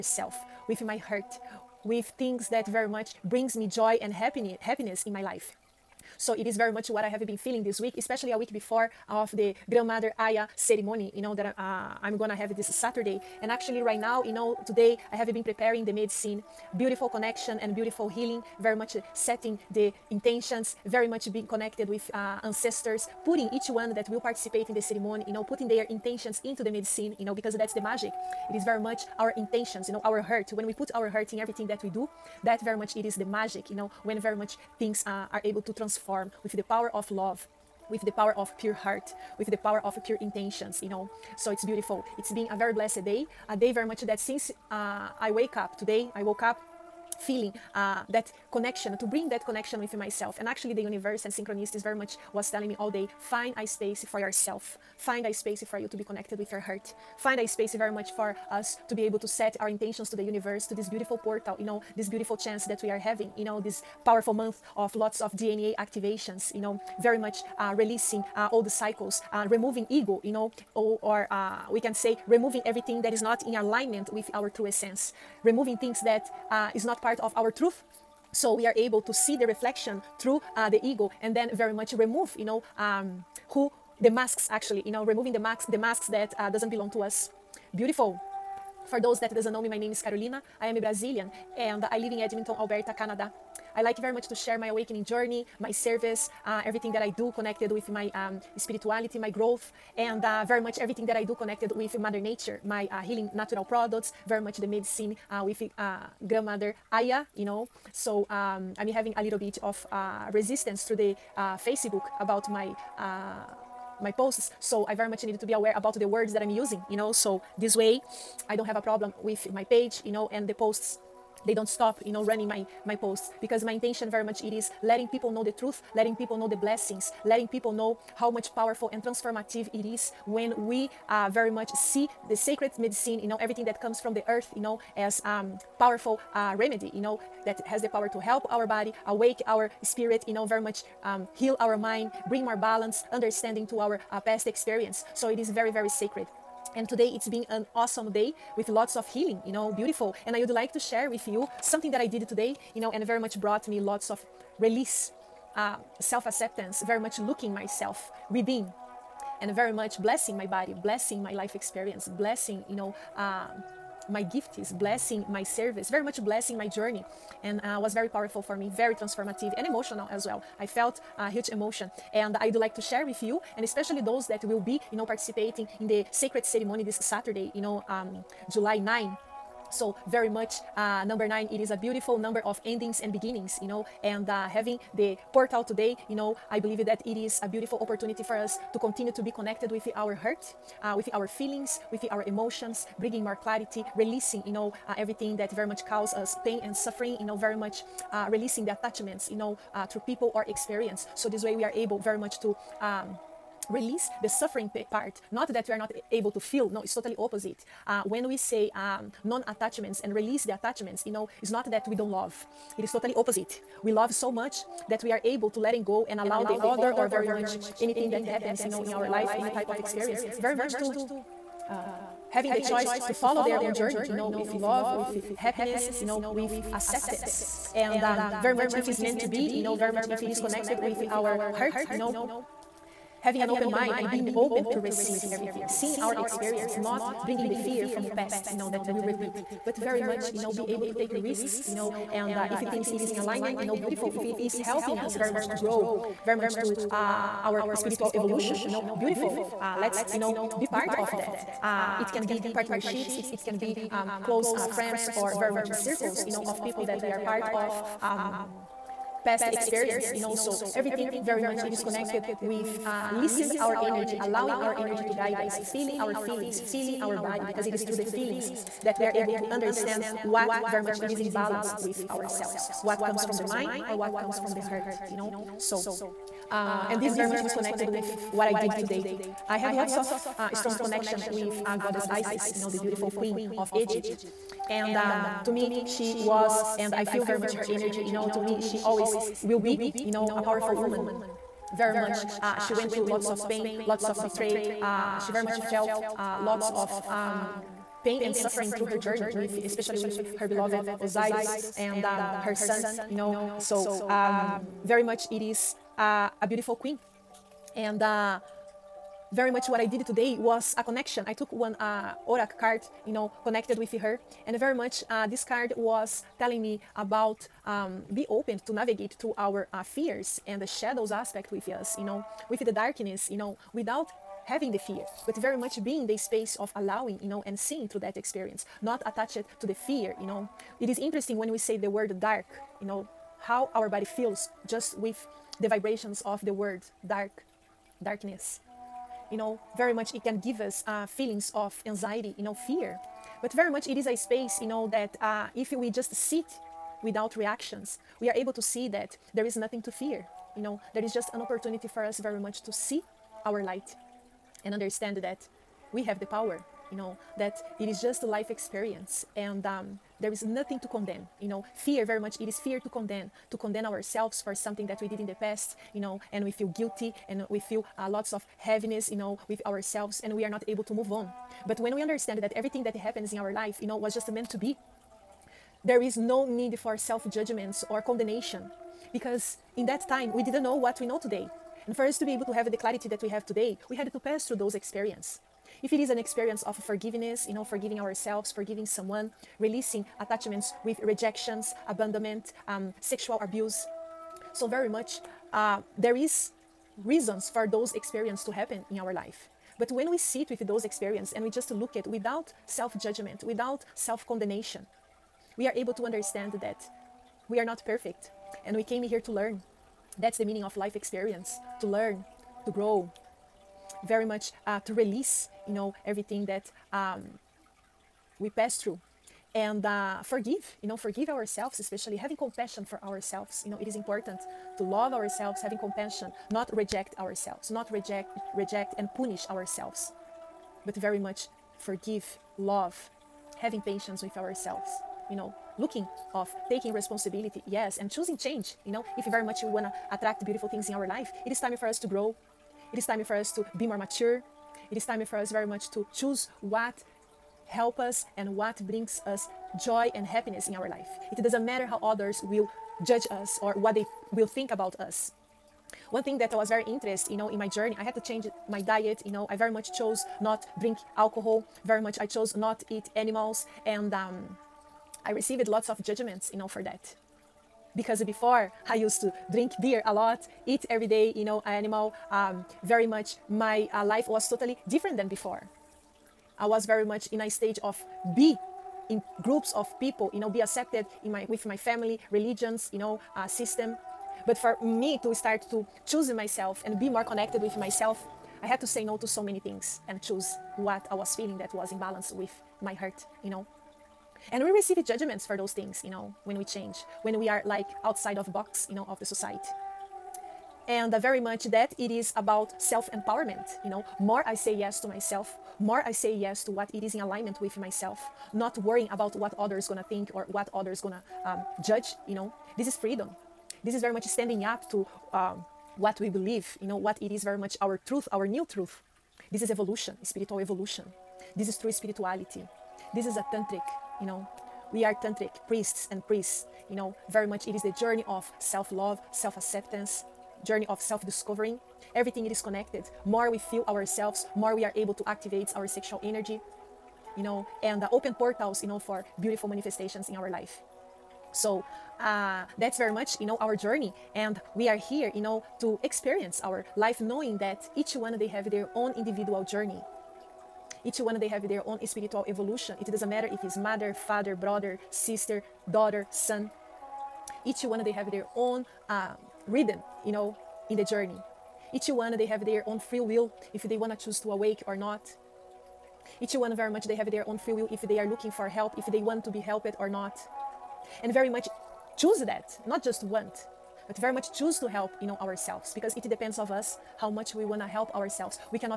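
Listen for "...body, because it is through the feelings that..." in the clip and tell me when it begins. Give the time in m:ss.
4:27.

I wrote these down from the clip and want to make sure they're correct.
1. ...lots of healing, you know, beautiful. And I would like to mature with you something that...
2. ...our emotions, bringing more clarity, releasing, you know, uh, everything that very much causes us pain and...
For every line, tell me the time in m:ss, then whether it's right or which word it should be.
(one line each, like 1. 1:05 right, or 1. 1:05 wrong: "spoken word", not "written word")
1. 2:28 wrong: "share", not "mature"
2. 3:12 right.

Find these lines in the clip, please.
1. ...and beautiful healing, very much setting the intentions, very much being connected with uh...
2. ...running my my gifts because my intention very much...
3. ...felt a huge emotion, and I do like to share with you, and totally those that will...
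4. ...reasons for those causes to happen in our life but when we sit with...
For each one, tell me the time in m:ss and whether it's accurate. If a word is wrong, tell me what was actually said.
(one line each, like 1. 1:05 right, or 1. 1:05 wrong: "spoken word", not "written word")
1. 0:17 right
2. 2:02 wrong: "posts", not "gifts"
3. 2:50 wrong: "especially", not "totally"
4. 6:37 wrong: "experiences", not "causes".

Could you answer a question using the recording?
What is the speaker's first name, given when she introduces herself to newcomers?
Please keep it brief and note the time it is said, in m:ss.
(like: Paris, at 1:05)
Carolina, at 1:30.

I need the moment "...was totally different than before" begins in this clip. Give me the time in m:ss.
7:54.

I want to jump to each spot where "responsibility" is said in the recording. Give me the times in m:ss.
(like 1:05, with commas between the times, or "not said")
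7:16.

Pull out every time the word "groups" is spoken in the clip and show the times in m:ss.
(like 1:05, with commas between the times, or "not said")
7:59.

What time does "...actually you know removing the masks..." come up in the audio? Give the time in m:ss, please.
1:24.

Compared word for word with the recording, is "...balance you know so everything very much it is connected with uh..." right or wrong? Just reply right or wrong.
wrong.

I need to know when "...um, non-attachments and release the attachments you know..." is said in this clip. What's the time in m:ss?
3:28.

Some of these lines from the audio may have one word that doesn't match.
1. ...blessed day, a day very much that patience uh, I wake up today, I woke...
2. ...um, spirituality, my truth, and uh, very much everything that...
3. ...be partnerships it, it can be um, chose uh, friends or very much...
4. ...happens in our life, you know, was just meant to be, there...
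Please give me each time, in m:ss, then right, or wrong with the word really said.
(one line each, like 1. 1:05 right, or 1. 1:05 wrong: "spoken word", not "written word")
1. 0:42 wrong: "since", not "patience"
2. 1:38 wrong: "growth", not "truth"
3. 4:12 wrong: "close", not "chose"
4. 6:12 right.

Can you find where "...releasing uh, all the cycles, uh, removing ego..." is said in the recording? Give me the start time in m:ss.
1:07.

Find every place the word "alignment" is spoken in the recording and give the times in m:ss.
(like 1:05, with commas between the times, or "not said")
1:13, 4:03, 8:27.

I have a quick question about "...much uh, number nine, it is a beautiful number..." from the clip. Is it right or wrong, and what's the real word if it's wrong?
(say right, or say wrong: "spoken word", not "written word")
right.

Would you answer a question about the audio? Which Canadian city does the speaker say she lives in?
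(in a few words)
Edmonton.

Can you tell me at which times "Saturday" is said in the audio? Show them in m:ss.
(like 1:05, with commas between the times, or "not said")
0:12, 2:56.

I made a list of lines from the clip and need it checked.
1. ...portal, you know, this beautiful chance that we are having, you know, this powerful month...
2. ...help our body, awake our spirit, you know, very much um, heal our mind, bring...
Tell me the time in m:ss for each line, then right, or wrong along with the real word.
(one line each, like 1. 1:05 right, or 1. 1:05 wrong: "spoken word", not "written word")
1. 1:01 right
2. 2:18 right.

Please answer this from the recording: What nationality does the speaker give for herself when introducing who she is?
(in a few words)
Brazilian.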